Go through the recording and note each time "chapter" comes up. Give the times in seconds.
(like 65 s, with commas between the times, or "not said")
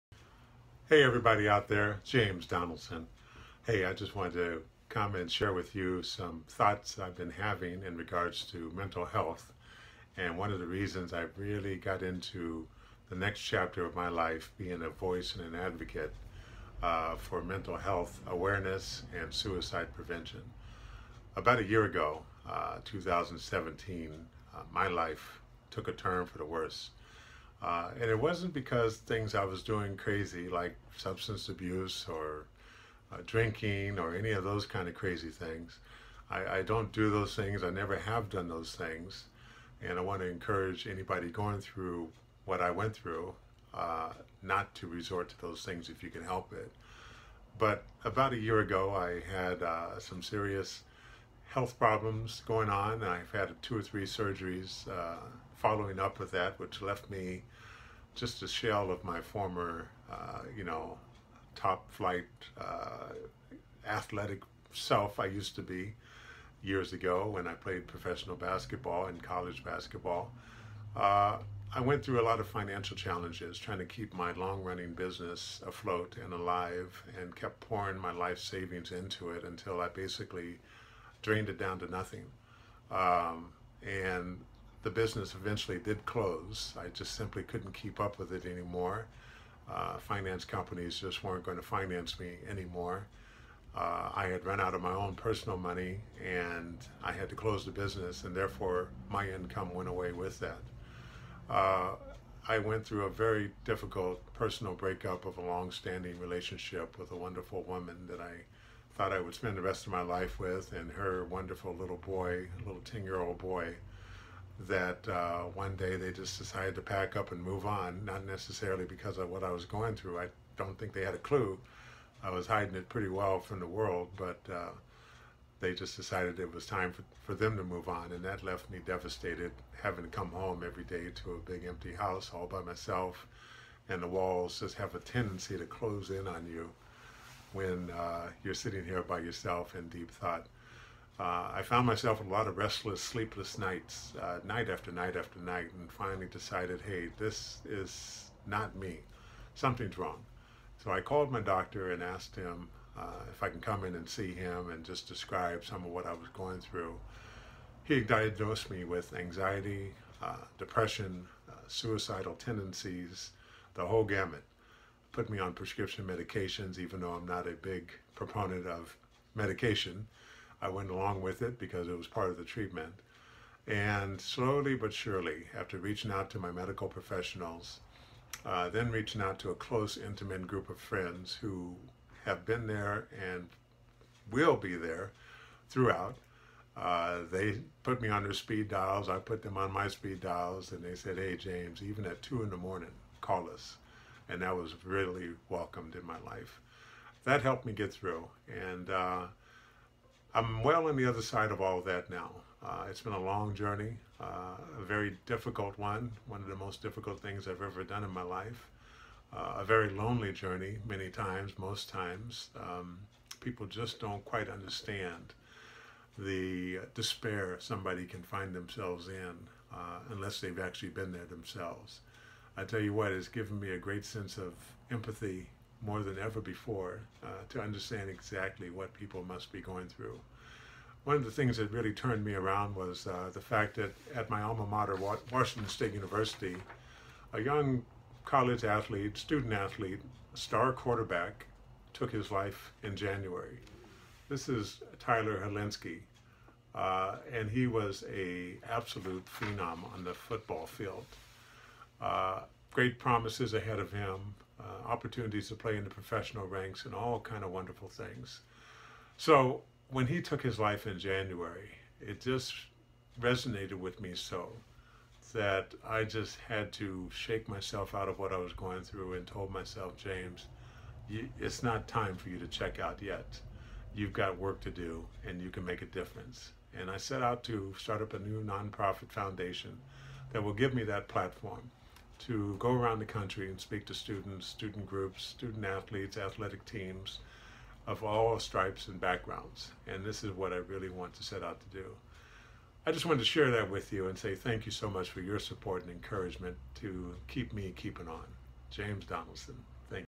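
13 s.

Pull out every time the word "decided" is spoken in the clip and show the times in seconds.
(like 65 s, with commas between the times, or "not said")
116 s, 125 s, 146 s.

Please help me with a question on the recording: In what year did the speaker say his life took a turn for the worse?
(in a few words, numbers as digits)
2017.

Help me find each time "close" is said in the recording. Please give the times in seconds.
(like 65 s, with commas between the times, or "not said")
86 s, 97 s, 135 s, 179 s.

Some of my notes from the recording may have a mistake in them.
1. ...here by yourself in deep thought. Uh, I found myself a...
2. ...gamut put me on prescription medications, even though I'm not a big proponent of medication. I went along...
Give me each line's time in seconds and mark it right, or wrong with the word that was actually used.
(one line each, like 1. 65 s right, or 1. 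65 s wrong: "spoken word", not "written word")
1. 138 s right
2. 164 s right.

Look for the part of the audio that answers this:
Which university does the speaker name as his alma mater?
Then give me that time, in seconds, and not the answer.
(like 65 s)
235 s.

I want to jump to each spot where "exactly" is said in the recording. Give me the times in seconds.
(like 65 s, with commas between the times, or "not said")
228 s.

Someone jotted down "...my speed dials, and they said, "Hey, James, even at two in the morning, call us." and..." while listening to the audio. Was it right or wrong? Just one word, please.
right.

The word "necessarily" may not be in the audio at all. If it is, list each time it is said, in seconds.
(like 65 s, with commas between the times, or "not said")
118 s.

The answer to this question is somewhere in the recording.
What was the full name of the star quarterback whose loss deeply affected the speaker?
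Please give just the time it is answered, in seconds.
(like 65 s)
244 s.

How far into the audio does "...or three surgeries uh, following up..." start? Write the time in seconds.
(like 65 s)
53 s.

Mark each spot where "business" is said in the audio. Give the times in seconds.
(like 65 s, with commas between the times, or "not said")
74 s, 84 s, 97 s.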